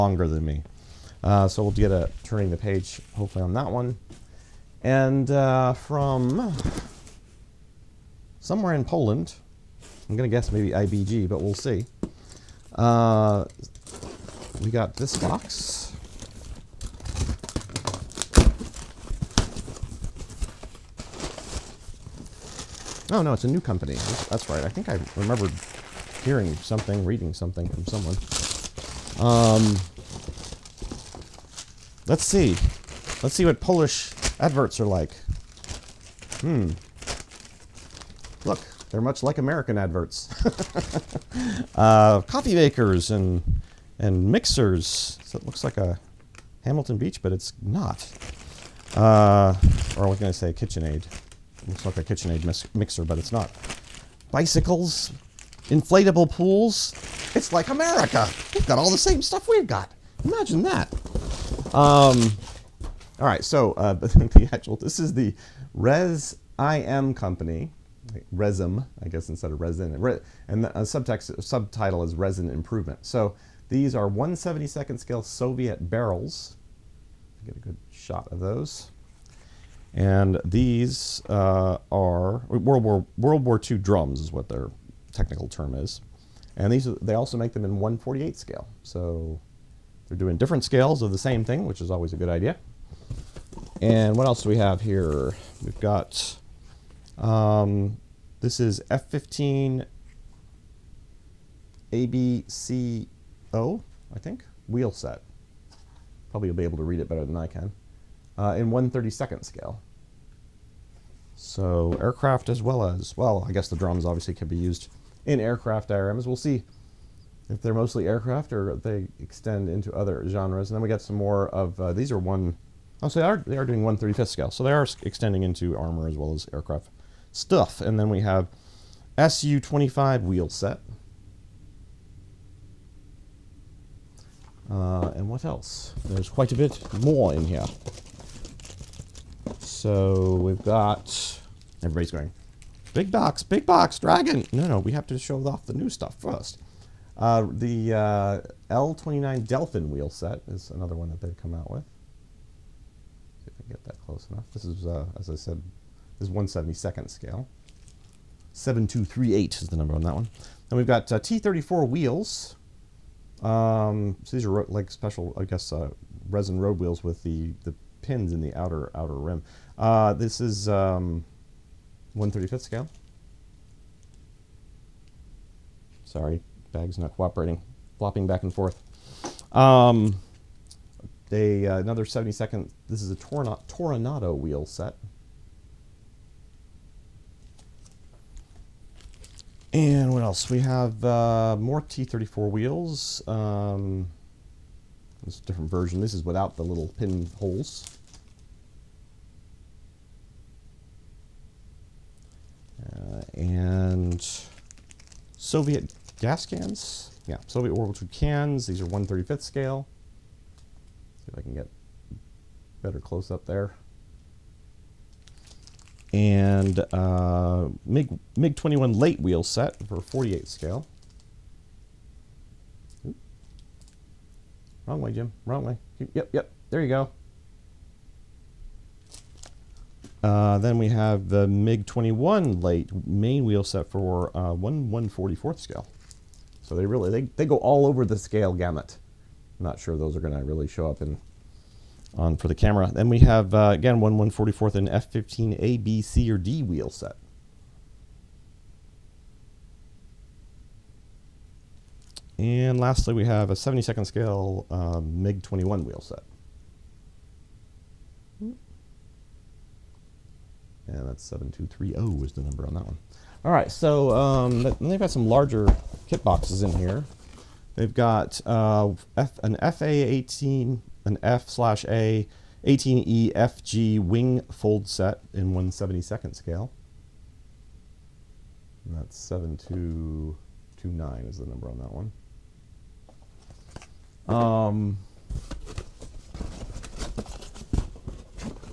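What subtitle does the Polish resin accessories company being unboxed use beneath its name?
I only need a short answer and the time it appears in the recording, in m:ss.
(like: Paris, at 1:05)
Resin Improvement, at 1:12.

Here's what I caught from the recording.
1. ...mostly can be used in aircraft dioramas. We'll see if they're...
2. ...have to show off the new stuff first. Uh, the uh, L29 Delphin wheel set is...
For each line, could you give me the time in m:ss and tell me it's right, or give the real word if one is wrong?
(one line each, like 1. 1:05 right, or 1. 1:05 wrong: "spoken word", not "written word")
1. 1:54 wrong: "obviously", not "mostly"
2. 2:24 right.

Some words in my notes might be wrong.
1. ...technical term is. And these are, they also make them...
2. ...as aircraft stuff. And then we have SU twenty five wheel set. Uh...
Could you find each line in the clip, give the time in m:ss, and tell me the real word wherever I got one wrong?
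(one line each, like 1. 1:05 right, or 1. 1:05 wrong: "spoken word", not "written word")
1. 1:25 right
2. 2:06 right.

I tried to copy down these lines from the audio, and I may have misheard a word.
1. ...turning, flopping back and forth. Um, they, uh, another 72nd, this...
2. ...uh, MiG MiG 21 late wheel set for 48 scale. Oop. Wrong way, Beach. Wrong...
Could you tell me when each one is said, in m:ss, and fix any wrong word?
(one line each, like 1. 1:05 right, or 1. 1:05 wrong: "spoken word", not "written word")
1. 2:57 wrong: "cooperating", not "turning"
2. 3:36 wrong: "Jim", not "Beach".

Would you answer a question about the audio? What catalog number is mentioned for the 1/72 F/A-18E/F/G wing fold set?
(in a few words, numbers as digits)
7229.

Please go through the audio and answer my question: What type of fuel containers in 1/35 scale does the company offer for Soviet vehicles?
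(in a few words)
Soviet gas cans.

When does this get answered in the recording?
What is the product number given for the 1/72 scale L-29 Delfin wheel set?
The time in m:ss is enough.
2:38.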